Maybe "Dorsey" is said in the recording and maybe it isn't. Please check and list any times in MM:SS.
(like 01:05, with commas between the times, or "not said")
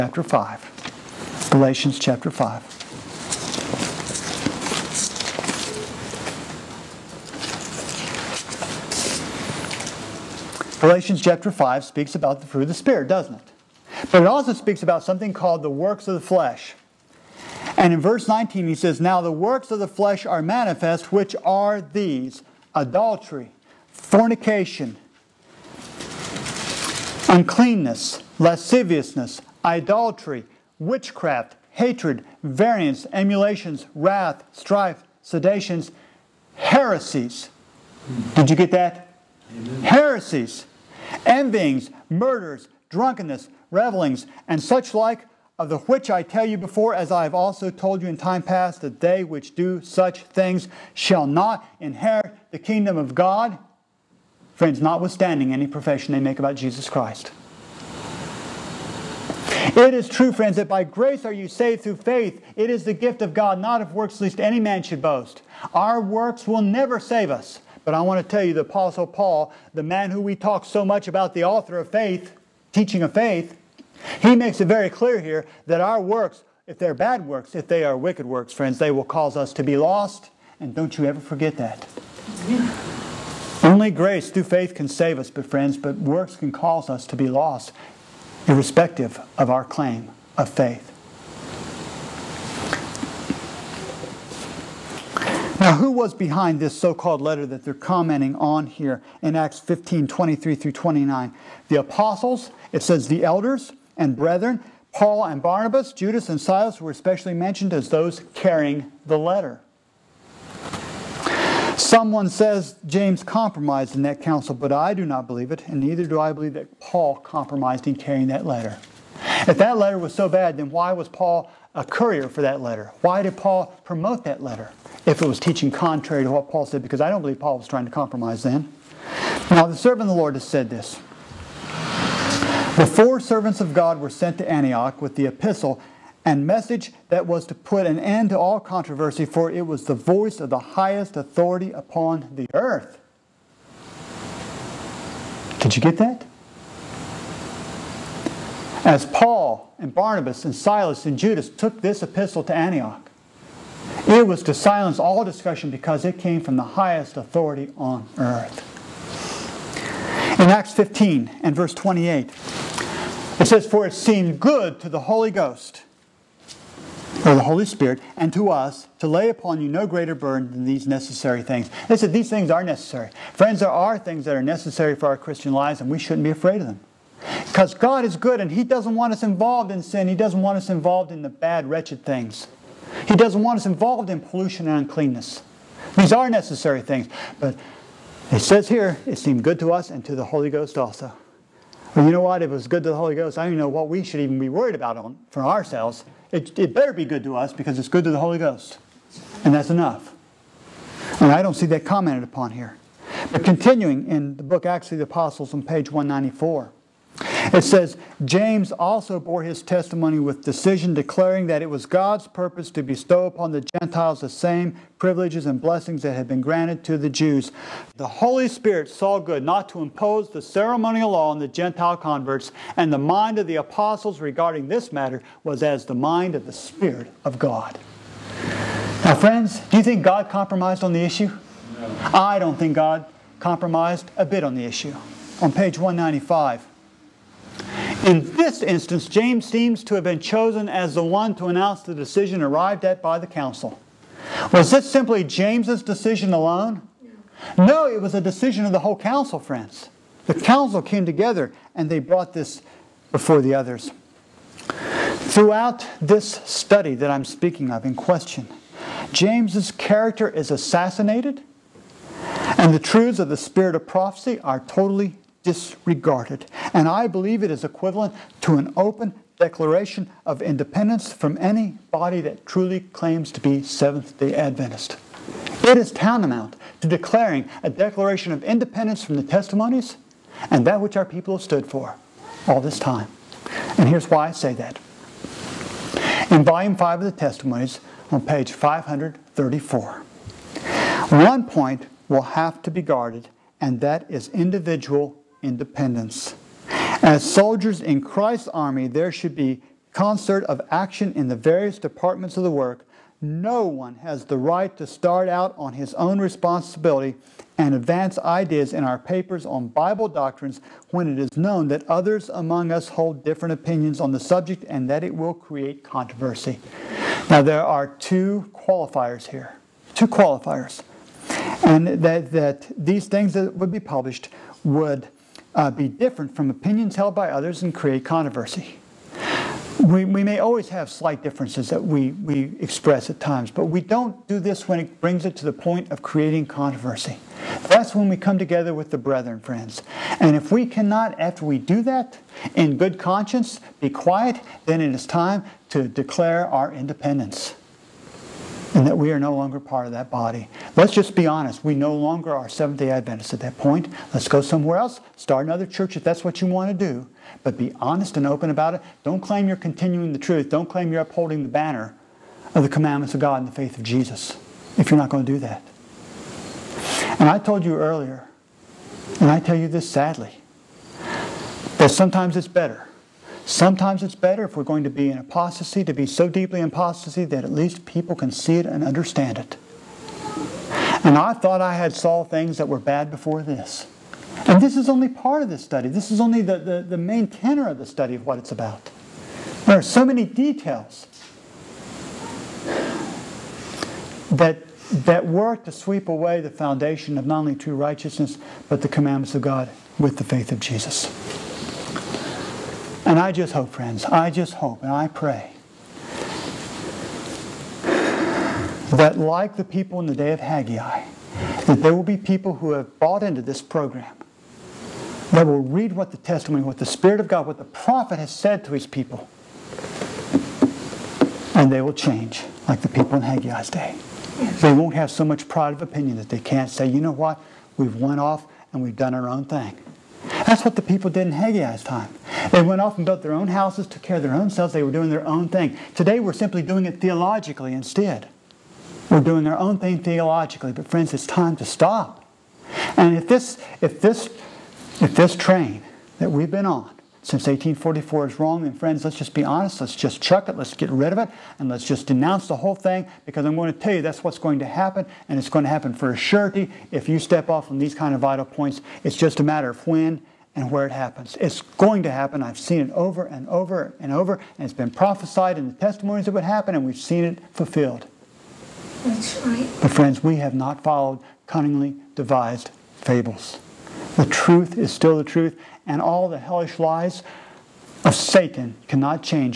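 not said.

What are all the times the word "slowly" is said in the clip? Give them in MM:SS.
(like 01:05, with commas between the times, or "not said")
not said.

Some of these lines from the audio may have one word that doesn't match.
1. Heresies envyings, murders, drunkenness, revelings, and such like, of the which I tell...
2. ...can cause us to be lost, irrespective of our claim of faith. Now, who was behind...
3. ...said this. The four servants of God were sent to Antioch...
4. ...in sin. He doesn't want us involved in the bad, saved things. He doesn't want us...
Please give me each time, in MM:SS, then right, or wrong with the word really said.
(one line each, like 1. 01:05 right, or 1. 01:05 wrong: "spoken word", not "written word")
1. 00:39 right
2. 01:26 right
3. 02:10 right
4. 02:59 wrong: "wretched", not "saved".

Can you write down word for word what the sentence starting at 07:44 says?
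And it's been prophesied in the testimonies that would happen, and we've seen it fulfilled.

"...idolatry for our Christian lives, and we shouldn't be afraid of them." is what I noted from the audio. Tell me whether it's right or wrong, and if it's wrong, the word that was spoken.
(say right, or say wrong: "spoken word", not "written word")
wrong: "necessary", not "idolatry".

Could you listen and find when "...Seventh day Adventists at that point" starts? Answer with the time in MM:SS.
05:52.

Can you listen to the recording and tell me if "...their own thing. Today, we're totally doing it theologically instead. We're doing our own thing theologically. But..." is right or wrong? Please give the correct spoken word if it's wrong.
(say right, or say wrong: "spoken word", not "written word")
wrong: "simply", not "totally".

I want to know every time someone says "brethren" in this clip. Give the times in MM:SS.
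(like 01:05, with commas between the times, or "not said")
01:44, 05:38.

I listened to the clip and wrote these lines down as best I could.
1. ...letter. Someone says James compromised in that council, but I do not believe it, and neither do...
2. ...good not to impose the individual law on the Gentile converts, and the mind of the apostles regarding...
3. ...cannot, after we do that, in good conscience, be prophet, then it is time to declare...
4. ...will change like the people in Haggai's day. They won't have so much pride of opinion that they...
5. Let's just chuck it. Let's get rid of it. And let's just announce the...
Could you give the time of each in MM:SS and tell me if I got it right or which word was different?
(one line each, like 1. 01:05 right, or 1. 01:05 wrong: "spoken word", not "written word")
1. 01:49 right
2. 03:39 wrong: "ceremonial", not "individual"
3. 05:40 wrong: "quiet", not "prophet"
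4. 07:01 right
5. 07:29 wrong: "denounce", not "announce".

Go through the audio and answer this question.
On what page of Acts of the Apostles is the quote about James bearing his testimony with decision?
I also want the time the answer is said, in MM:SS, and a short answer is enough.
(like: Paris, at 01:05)
194, at 03:25.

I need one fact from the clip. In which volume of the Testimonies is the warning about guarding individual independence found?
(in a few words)
Volume 5.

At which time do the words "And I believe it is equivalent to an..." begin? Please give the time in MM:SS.
04:26.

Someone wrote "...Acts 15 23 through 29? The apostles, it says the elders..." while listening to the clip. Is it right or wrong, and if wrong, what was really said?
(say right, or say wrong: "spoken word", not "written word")
right.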